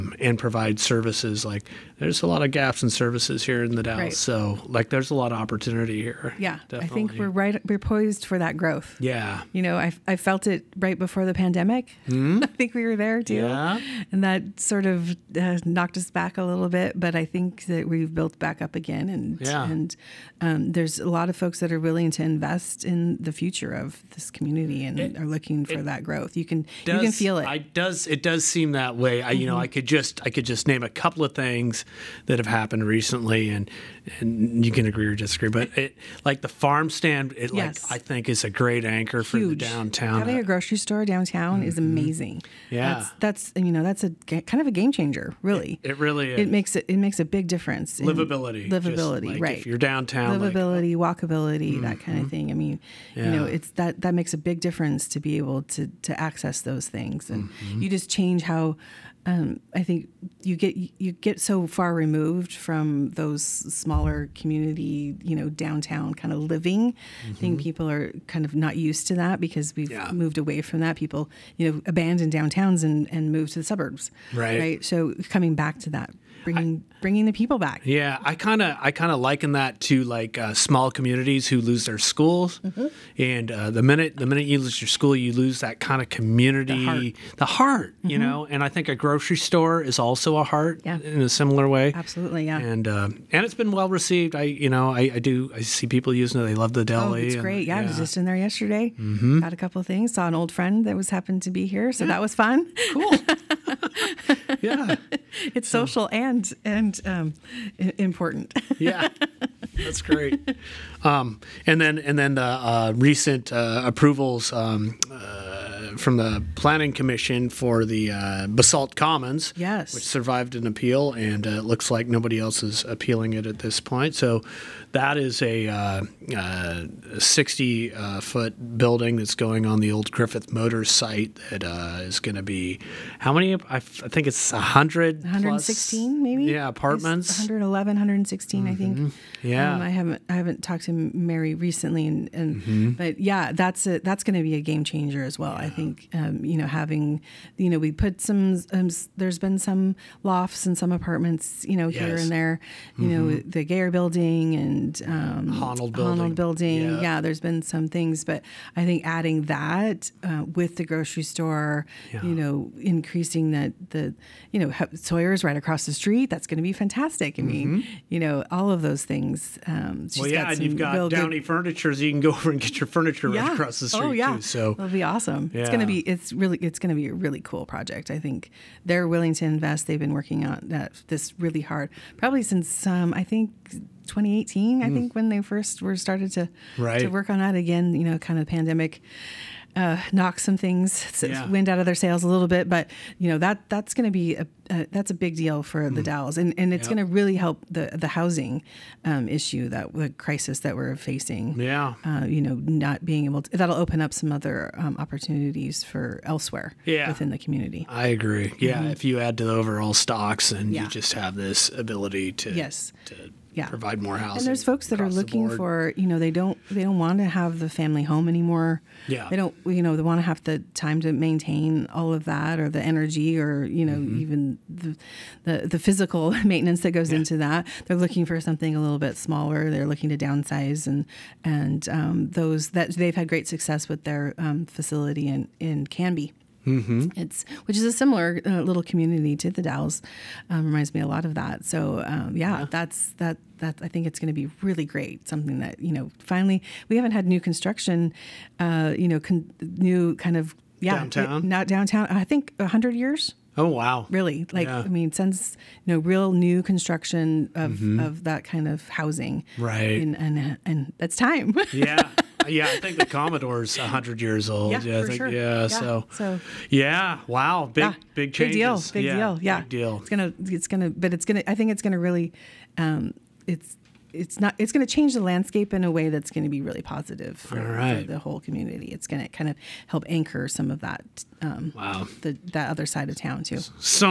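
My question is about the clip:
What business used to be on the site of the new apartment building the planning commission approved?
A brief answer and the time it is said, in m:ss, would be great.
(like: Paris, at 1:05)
Griffith Motors, at 2:10.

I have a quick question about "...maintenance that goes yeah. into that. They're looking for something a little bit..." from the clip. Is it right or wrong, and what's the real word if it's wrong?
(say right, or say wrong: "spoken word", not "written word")
right.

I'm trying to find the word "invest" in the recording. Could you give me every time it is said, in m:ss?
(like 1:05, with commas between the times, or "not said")
0:22, 2:59.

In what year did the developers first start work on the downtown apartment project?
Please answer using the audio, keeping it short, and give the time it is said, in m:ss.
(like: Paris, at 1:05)
2018, at 3:04.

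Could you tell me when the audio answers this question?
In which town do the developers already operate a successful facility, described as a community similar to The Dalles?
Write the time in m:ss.
3:55.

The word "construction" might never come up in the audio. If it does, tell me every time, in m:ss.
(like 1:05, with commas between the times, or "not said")
4:07, 4:16.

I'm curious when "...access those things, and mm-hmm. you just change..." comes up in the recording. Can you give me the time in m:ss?
0:56.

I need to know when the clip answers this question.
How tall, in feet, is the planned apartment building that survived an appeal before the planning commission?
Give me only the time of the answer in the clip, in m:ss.
2:07.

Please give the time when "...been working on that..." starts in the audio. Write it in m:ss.
2:59.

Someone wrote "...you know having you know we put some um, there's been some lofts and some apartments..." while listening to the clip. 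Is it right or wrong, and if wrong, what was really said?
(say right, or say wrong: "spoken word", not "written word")
right.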